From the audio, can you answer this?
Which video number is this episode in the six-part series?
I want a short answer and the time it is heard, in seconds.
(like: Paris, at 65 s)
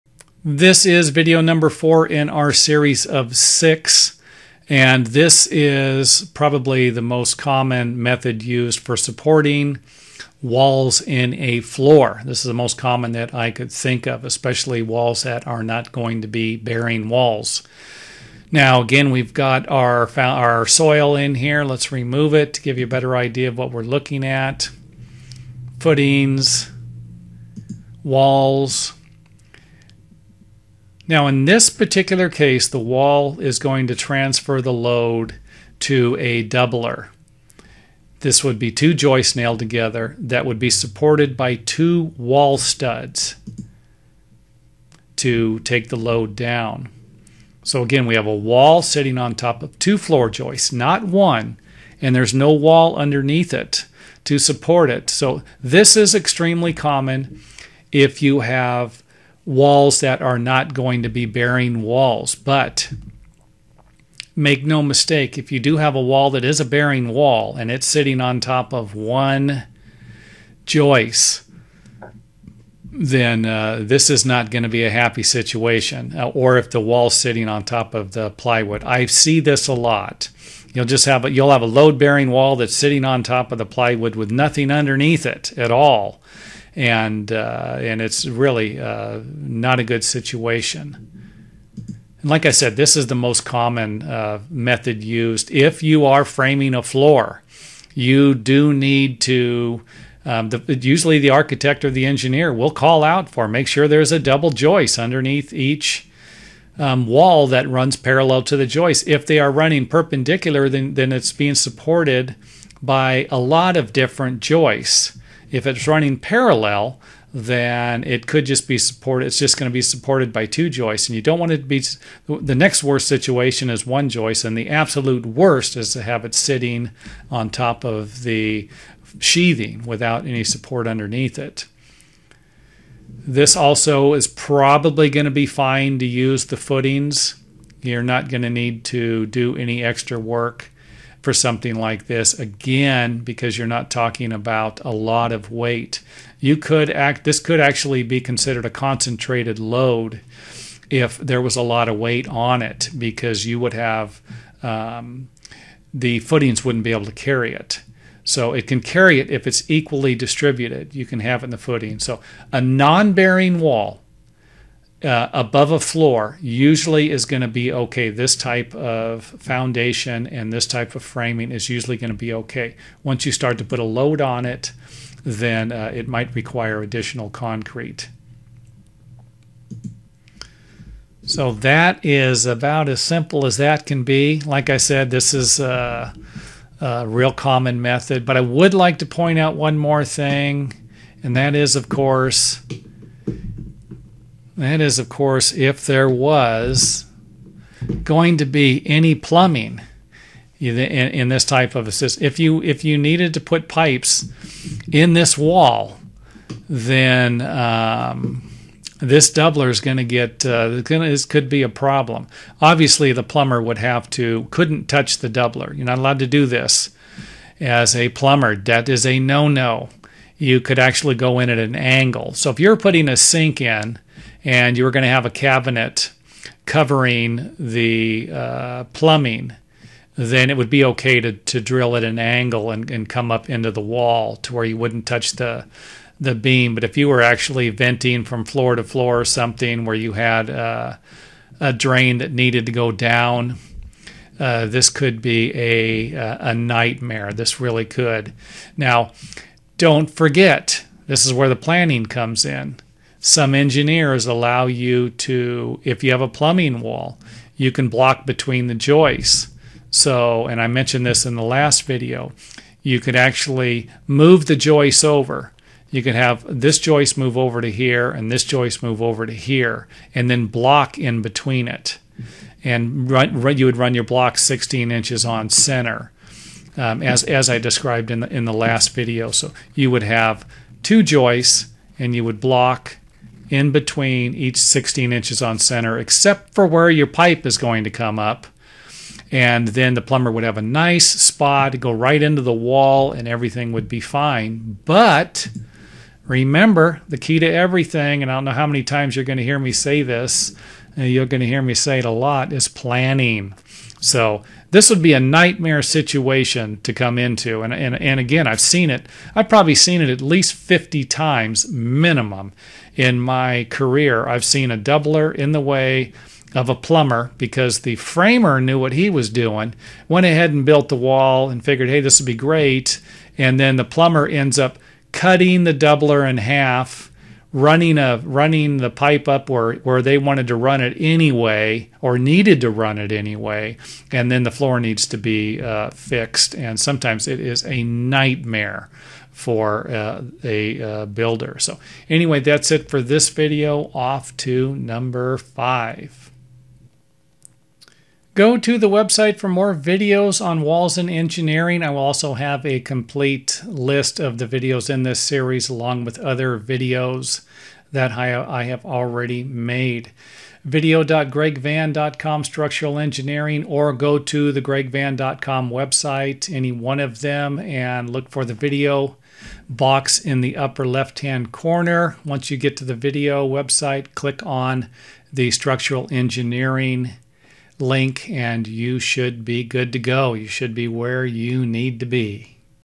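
4, at 1 s.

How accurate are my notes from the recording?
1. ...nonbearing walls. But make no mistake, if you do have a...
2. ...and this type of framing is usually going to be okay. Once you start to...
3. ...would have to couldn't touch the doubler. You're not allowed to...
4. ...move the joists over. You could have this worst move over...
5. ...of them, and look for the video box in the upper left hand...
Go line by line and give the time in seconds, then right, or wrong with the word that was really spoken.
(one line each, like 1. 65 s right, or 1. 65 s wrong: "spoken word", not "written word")
1. 61 s wrong: "bearing", not "nonbearing"
2. 170 s right
3. 213 s right
4. 264 s wrong: "joist", not "worst"
5. 366 s right.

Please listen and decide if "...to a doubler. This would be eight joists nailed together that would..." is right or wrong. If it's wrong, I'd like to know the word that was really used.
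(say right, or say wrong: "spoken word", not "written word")
wrong: "two", not "eight".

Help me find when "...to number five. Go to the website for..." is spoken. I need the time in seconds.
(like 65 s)
344 s.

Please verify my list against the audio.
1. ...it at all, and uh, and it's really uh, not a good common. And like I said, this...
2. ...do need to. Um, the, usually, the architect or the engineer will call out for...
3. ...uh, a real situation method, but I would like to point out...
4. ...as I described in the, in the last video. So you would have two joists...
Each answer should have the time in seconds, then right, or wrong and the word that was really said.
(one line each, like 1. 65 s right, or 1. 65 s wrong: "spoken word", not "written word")
1. 85 s wrong: "situation", not "common"
2. 98 s right
3. 186 s wrong: "common", not "situation"
4. 277 s right.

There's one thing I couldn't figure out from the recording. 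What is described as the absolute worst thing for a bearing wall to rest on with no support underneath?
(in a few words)
The sheathing.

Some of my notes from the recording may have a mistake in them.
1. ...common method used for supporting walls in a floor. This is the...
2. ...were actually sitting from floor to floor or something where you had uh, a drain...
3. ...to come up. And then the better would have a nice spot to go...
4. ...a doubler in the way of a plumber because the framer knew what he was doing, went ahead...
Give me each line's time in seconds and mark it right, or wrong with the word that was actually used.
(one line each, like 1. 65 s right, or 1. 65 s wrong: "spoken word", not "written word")
1. 7 s right
2. 237 s wrong: "venting", not "sitting"
3. 287 s wrong: "plumber", not "better"
4. 314 s right.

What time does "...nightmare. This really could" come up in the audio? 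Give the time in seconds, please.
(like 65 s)
246 s.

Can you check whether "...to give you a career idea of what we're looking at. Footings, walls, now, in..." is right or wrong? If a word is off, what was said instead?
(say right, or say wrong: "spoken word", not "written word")
wrong: "better", not "career".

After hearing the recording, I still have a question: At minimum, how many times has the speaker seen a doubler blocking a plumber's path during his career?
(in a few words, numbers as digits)
50.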